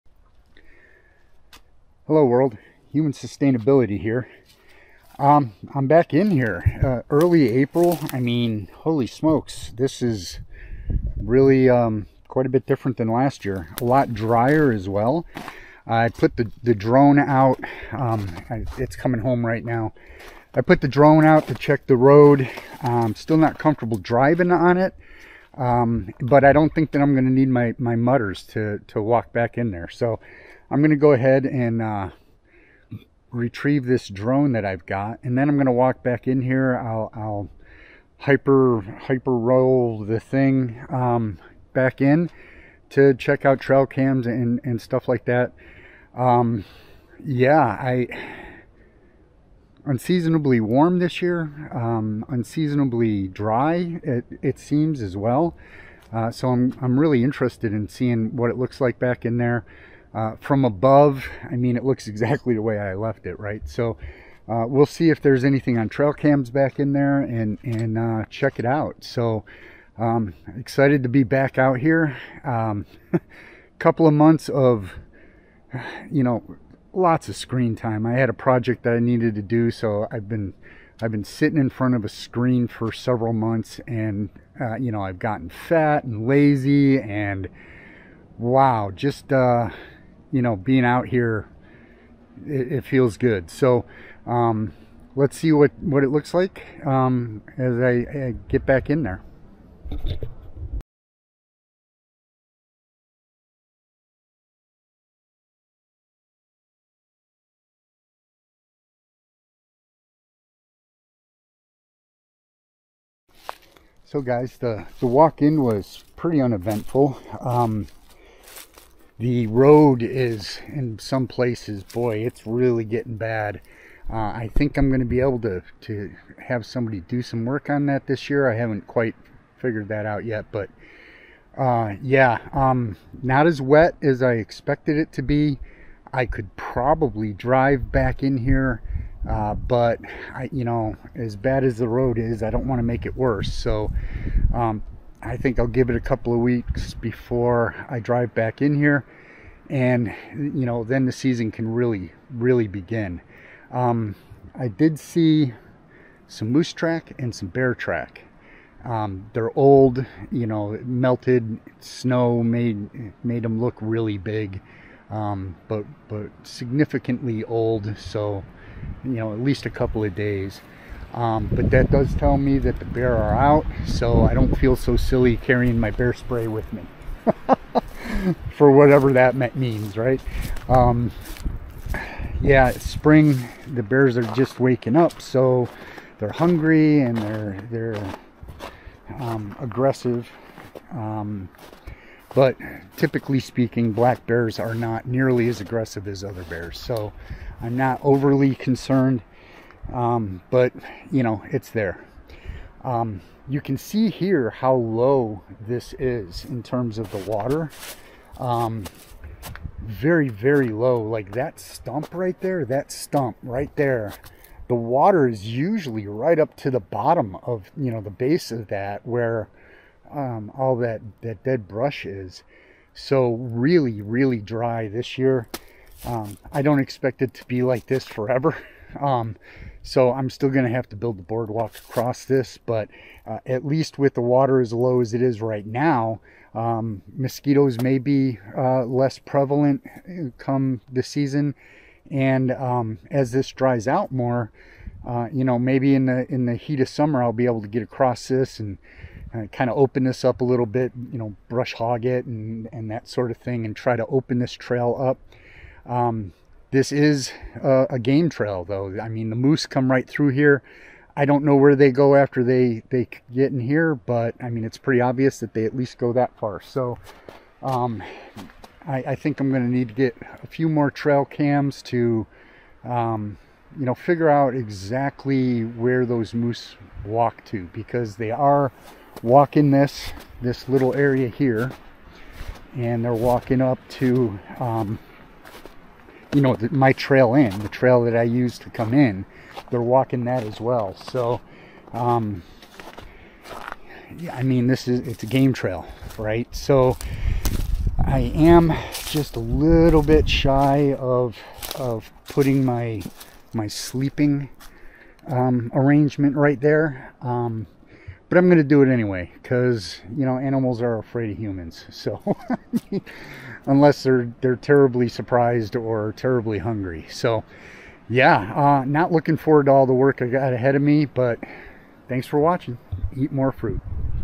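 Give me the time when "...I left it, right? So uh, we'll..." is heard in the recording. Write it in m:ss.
1:02.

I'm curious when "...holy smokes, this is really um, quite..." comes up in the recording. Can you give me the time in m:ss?
0:08.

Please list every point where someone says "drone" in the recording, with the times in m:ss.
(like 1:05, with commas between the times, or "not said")
0:16, 0:20, 0:34.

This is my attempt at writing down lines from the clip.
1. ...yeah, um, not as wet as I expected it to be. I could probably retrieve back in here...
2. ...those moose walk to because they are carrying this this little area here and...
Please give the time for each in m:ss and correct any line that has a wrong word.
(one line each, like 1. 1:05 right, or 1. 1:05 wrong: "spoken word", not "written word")
1. 2:12 wrong: "drive", not "retrieve"
2. 4:36 wrong: "walking", not "carrying".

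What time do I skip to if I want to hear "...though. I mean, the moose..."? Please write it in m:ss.
4:18.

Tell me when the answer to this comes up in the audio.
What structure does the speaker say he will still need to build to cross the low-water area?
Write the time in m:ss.
3:51.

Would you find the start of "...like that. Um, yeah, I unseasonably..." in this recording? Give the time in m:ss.
0:45.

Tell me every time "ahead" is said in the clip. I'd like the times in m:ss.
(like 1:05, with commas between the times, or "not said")
0:31, 5:20.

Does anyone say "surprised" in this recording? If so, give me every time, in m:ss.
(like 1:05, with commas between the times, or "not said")
5:15.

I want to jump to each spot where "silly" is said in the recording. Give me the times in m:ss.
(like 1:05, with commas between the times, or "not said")
2:54.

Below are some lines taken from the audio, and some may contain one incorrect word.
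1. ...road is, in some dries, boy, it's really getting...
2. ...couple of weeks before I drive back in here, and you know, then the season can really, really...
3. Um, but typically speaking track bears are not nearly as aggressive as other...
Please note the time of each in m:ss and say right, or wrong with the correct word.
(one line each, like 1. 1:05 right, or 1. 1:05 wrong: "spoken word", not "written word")
1. 1:59 wrong: "places", not "dries"
2. 2:26 right
3. 3:10 wrong: "black", not "track".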